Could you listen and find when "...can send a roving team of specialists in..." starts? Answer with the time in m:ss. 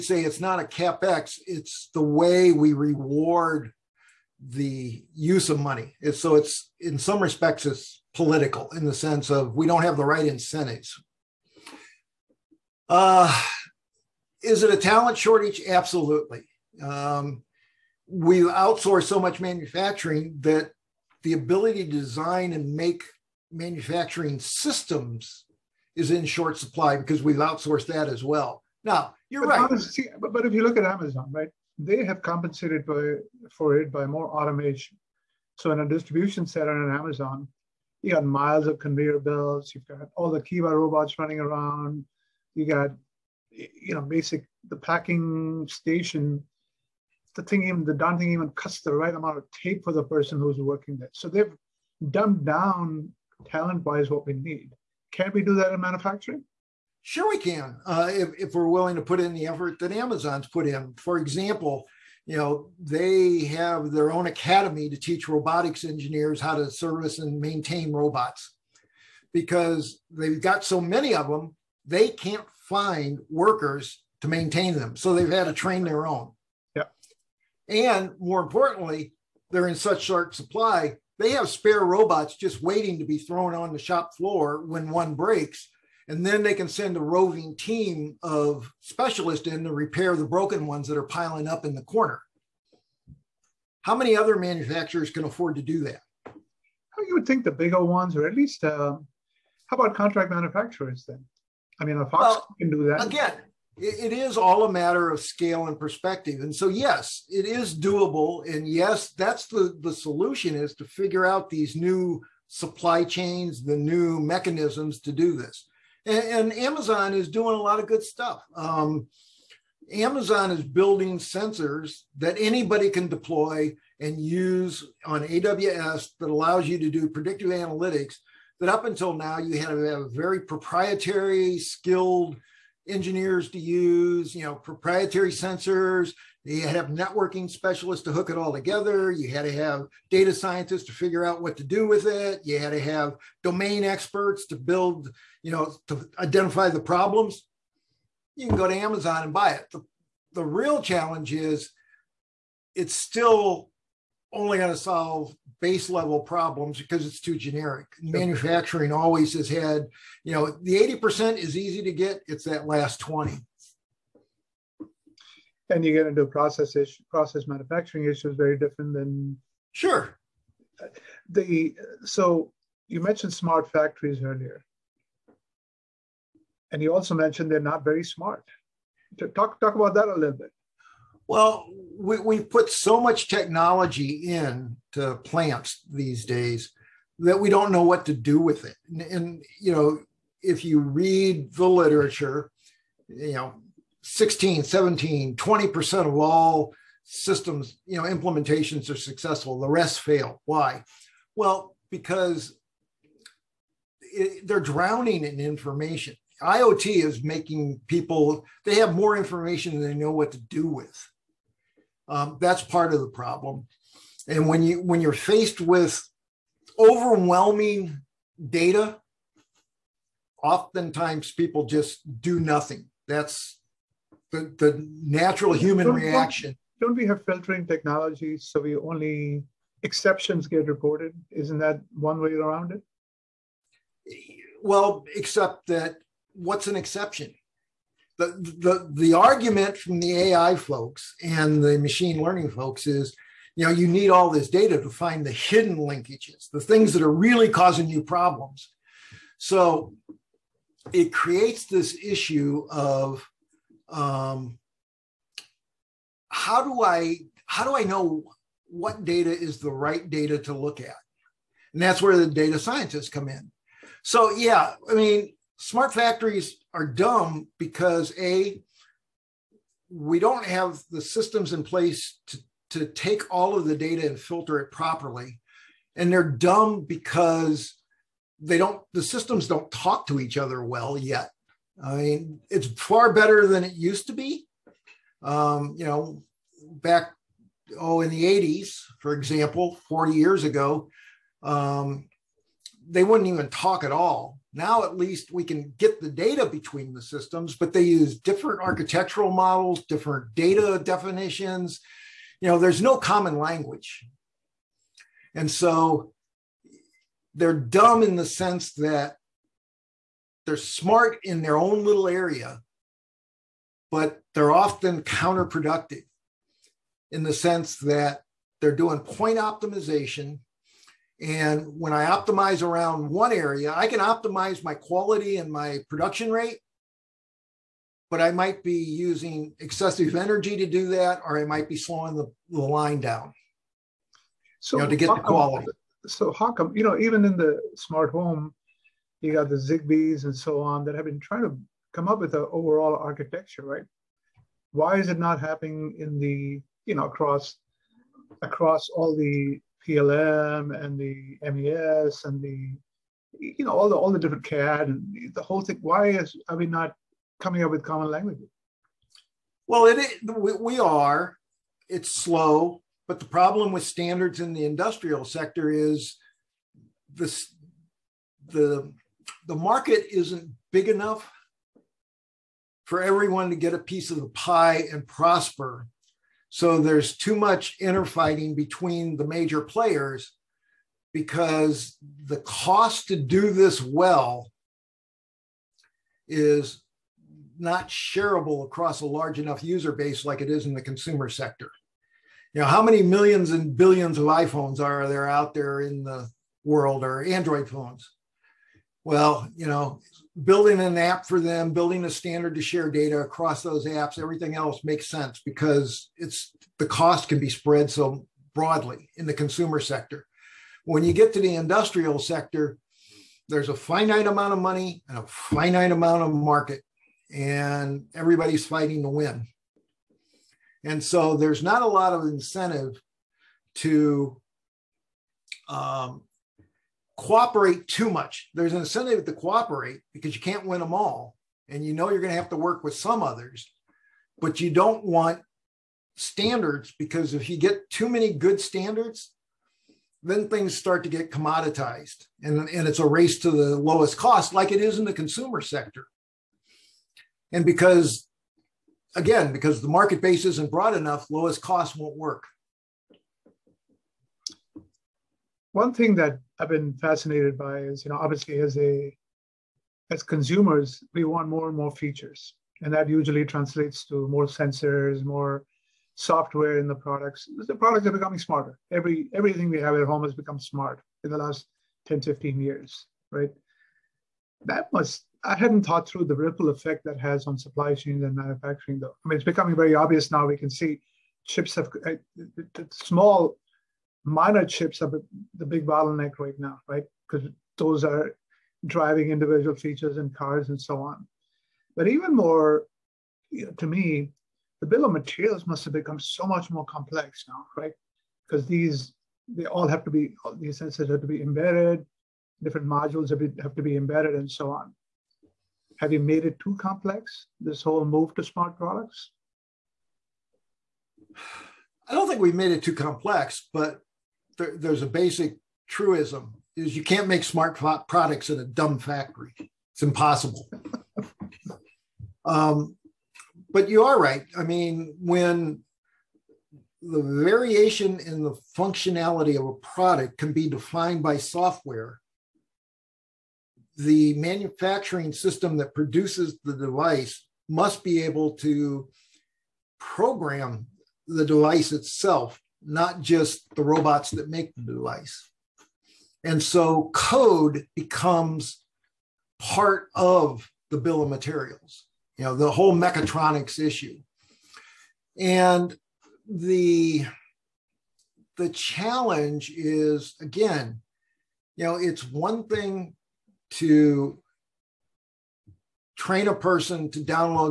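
1:26.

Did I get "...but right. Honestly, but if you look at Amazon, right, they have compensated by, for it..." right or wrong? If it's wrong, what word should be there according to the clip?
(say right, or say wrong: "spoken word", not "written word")
right.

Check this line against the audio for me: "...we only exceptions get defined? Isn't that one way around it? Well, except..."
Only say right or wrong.
wrong.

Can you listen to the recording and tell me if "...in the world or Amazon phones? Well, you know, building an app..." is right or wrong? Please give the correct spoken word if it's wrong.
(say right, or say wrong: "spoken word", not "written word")
wrong: "Android", not "Amazon".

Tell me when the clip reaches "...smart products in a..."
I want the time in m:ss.
8:37.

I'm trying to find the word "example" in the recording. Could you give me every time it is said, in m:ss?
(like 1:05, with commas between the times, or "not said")
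1:01, 4:49.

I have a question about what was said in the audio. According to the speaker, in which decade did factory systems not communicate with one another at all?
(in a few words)
the 80s.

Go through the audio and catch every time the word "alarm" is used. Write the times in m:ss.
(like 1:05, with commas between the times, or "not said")
not said.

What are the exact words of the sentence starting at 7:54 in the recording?
That must I hadn't thought through the ripple effect that has on supply chains and manufacturing, though.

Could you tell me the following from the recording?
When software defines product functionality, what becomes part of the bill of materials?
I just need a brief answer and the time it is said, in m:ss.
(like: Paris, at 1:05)
code, at 9:07.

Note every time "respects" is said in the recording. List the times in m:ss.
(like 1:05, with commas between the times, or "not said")
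0:07.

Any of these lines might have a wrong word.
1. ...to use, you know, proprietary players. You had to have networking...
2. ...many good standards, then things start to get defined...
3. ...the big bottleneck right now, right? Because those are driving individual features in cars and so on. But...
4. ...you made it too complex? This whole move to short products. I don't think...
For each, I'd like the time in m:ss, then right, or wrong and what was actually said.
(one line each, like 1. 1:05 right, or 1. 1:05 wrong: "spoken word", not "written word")
1. 2:13 wrong: "sensors", not "players"
2. 7:18 wrong: "commoditized", not "defined"
3. 8:05 right
4. 8:26 wrong: "smart", not "short".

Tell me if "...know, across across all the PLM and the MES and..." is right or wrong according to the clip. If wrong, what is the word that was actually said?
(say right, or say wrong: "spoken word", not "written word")
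right.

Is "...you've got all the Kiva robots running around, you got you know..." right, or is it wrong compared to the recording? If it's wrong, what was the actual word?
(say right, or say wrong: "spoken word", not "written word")
right.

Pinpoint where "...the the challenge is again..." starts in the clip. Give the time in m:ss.
9:16.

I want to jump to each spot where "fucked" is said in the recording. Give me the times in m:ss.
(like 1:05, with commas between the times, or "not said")
not said.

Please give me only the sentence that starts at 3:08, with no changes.
And, and you know, if you read the literature, you know, 16, 17, 20% of all systems, you know, implementations are successful.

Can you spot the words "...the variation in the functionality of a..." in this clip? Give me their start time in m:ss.
8:47.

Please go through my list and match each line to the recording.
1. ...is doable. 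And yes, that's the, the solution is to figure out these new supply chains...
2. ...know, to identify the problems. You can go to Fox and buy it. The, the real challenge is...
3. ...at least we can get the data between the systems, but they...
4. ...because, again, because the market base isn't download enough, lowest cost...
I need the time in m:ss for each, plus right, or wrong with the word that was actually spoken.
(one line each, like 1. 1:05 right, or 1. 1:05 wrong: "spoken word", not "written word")
1. 1:47 right
2. 2:25 wrong: "Amazon", not "Fox"
3. 4:54 right
4. 7:27 wrong: "broad", not "download".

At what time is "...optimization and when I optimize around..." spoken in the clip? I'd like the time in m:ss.
5:19.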